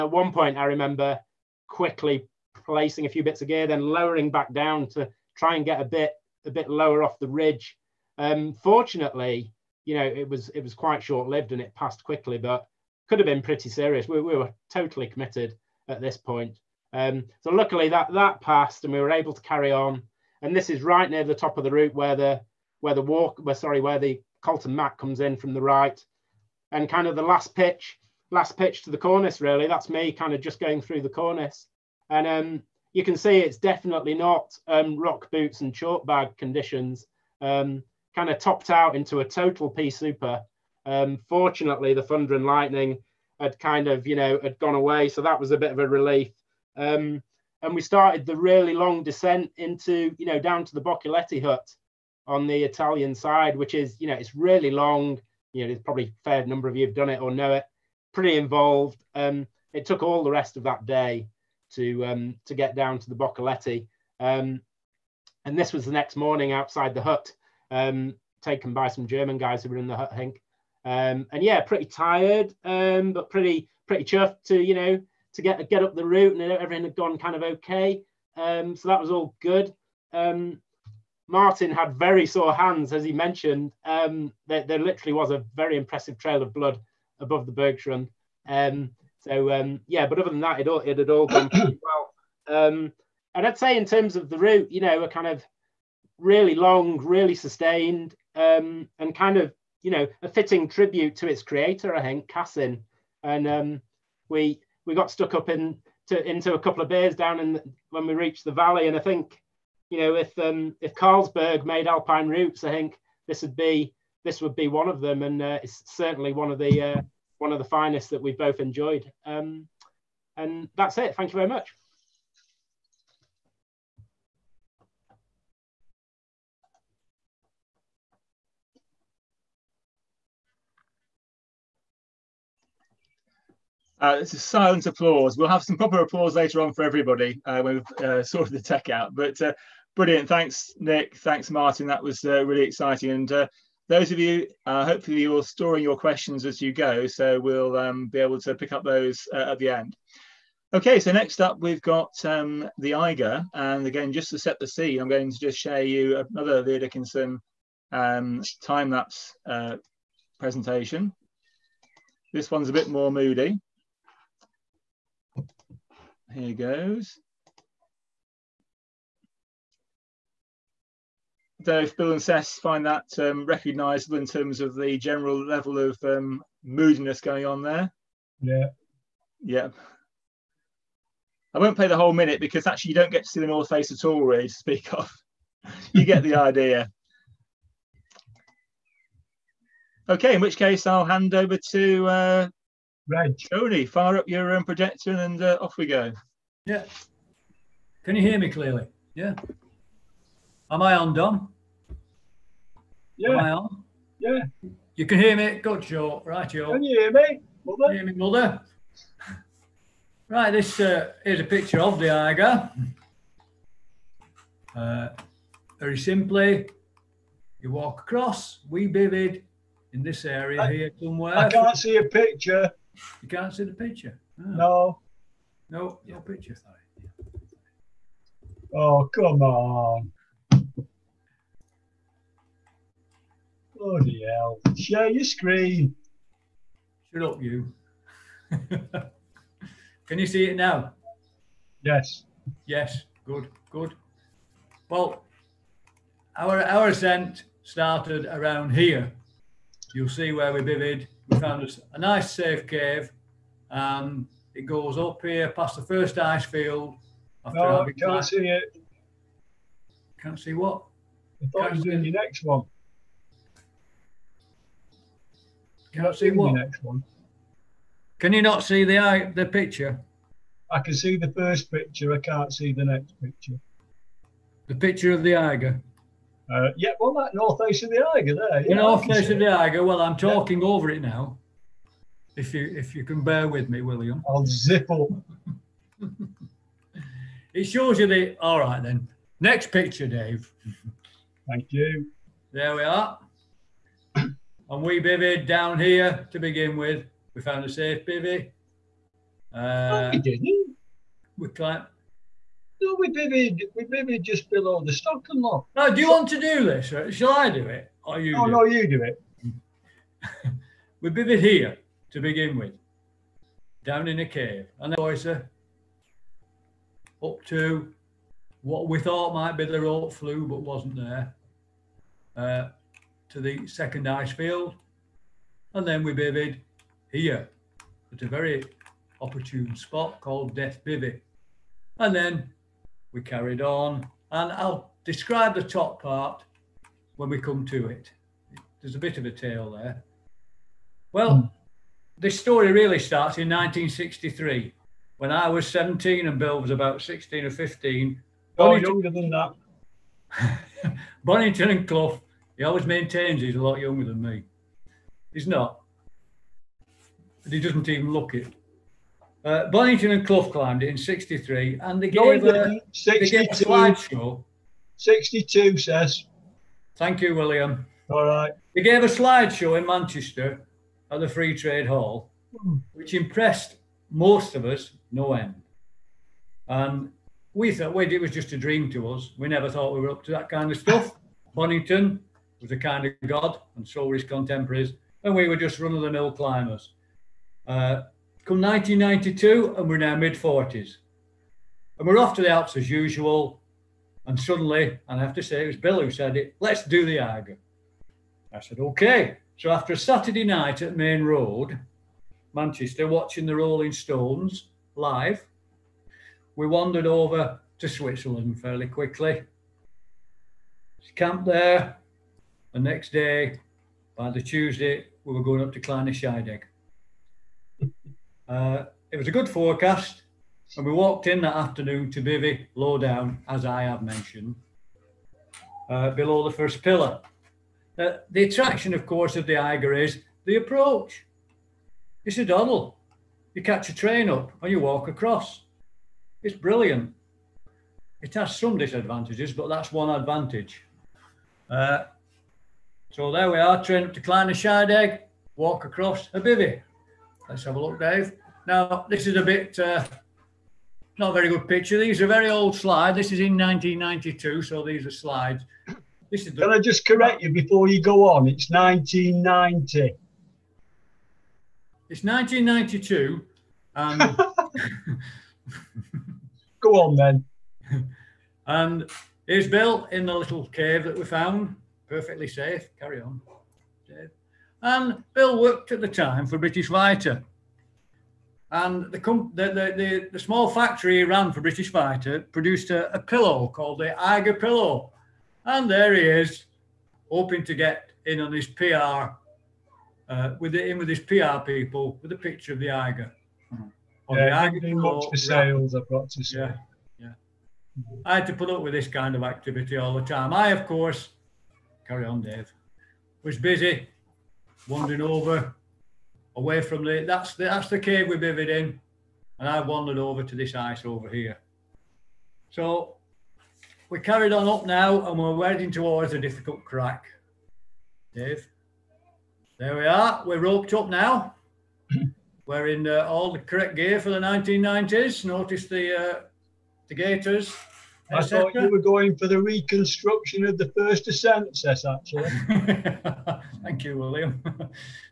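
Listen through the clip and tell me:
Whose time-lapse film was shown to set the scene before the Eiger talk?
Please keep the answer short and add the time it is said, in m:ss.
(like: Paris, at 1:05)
Leo Dickinson, at 2:36.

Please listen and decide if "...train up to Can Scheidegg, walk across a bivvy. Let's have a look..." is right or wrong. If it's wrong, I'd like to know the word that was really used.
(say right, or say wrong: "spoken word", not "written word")
wrong: "Kleiner", not "Can".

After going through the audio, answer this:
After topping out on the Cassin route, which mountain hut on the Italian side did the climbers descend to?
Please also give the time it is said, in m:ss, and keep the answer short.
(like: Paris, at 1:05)
Boccalatte hut, at 0:50.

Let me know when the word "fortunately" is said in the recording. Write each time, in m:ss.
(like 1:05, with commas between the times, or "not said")
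0:08, 0:41.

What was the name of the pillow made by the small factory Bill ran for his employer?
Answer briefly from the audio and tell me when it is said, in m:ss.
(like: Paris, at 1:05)
Eiger Pillow, at 8:04.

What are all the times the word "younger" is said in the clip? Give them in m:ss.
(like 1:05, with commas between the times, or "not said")
5:48, 5:53.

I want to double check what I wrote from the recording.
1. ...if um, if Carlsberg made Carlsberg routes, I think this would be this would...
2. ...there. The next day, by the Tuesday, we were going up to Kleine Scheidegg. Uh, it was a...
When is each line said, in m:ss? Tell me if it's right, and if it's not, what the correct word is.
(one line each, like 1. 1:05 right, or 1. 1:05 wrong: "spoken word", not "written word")
1. 1:50 wrong: "Alpine", not "Carlsberg"
2. 6:51 right.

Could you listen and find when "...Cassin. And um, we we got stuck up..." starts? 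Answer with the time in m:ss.
1:42.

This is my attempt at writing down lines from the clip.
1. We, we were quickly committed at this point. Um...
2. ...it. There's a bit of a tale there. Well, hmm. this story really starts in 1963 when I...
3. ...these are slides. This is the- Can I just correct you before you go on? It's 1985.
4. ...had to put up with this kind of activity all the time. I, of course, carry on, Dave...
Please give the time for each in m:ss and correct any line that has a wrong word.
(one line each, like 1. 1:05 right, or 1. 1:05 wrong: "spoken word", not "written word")
1. 0:14 wrong: "totally", not "quickly"
2. 5:37 right
3. 7:34 wrong: "1990", not "1985"
4. 8:18 right.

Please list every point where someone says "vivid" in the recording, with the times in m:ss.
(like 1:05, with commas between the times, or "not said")
3:38, 4:10, 8:28.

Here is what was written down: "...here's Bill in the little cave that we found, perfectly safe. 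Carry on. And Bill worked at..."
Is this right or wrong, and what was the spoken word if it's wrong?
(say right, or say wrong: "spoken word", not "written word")
right.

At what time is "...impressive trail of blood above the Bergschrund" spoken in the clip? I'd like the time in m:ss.
1:25.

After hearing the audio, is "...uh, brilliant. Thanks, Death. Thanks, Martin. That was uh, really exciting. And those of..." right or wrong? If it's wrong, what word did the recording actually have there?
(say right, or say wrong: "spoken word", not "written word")
wrong: "Nick", not "Death".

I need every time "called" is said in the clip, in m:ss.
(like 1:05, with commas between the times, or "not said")
5:30, 8:03.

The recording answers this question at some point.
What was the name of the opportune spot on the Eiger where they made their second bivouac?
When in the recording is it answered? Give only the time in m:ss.
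5:30.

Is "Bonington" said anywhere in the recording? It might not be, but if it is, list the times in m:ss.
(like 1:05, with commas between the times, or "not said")
5:51, 5:59, 6:21.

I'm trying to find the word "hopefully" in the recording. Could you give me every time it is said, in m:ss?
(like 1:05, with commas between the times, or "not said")
2:24.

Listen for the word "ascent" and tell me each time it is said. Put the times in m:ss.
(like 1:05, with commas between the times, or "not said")
4:06, 8:51.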